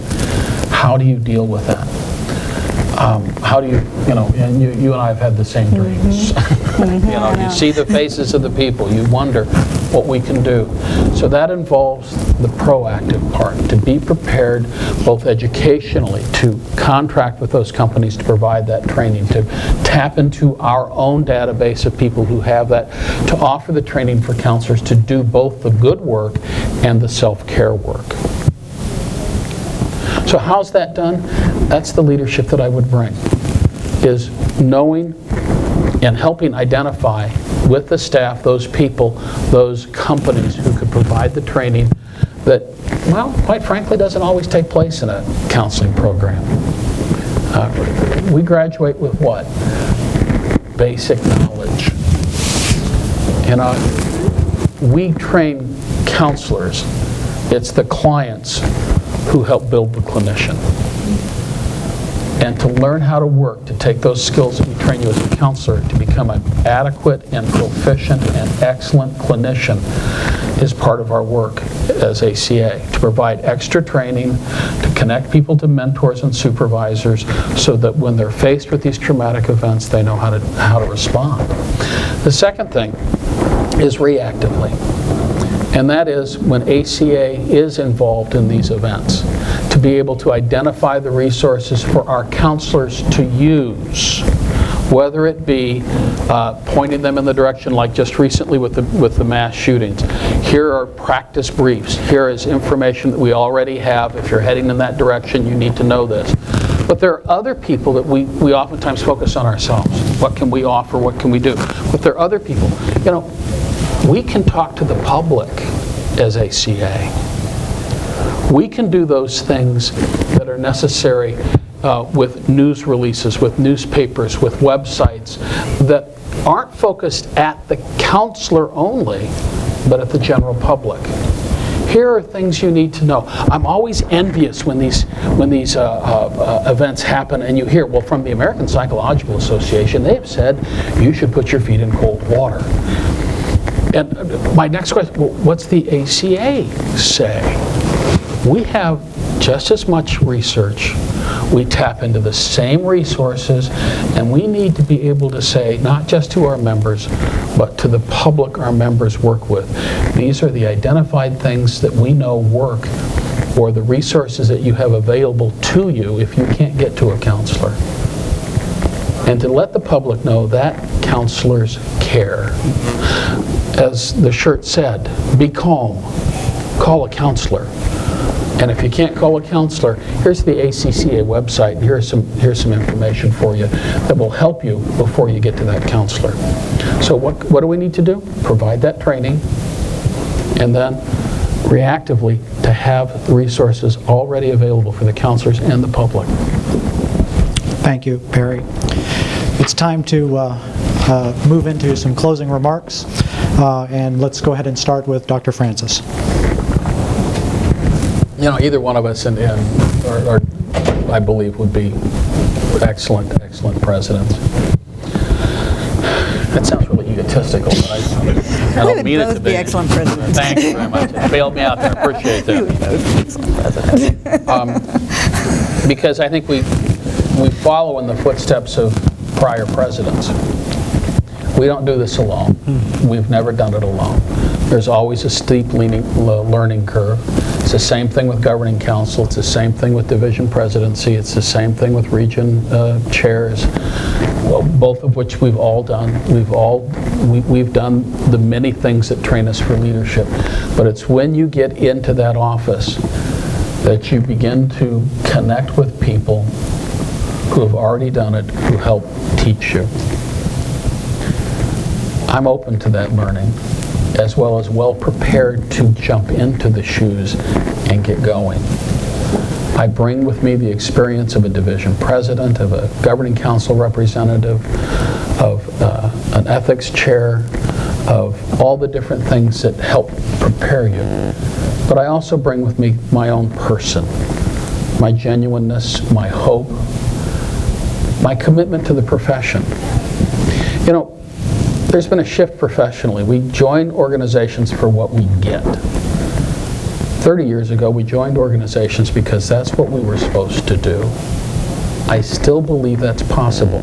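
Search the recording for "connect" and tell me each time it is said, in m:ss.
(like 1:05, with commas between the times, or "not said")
1:14, 4:15.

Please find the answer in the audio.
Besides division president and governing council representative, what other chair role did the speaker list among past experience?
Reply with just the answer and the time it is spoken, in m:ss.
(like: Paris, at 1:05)
ethics chair, at 4:36.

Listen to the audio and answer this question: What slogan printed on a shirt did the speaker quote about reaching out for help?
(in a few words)
be calm, call a counselor.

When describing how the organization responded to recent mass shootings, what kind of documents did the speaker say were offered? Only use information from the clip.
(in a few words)
practice briefs.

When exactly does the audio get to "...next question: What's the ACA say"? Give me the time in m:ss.
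2:24.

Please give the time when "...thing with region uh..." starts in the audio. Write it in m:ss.
4:01.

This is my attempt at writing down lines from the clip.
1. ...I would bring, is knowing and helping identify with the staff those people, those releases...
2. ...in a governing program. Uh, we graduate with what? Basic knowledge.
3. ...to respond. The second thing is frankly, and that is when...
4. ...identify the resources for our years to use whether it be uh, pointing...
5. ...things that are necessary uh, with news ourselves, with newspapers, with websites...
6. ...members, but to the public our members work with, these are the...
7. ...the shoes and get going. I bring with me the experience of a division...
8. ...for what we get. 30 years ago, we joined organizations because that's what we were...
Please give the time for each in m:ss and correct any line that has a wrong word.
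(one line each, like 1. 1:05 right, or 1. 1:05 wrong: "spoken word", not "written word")
1. 0:32 wrong: "companies", not "releases"
2. 0:45 wrong: "counseling", not "governing"
3. 1:20 wrong: "reactively", not "frankly"
4. 1:30 wrong: "counselors", not "years"
5. 1:59 wrong: "releases", not "ourselves"
6. 2:36 right
7. 4:26 right
8. 4:54 right.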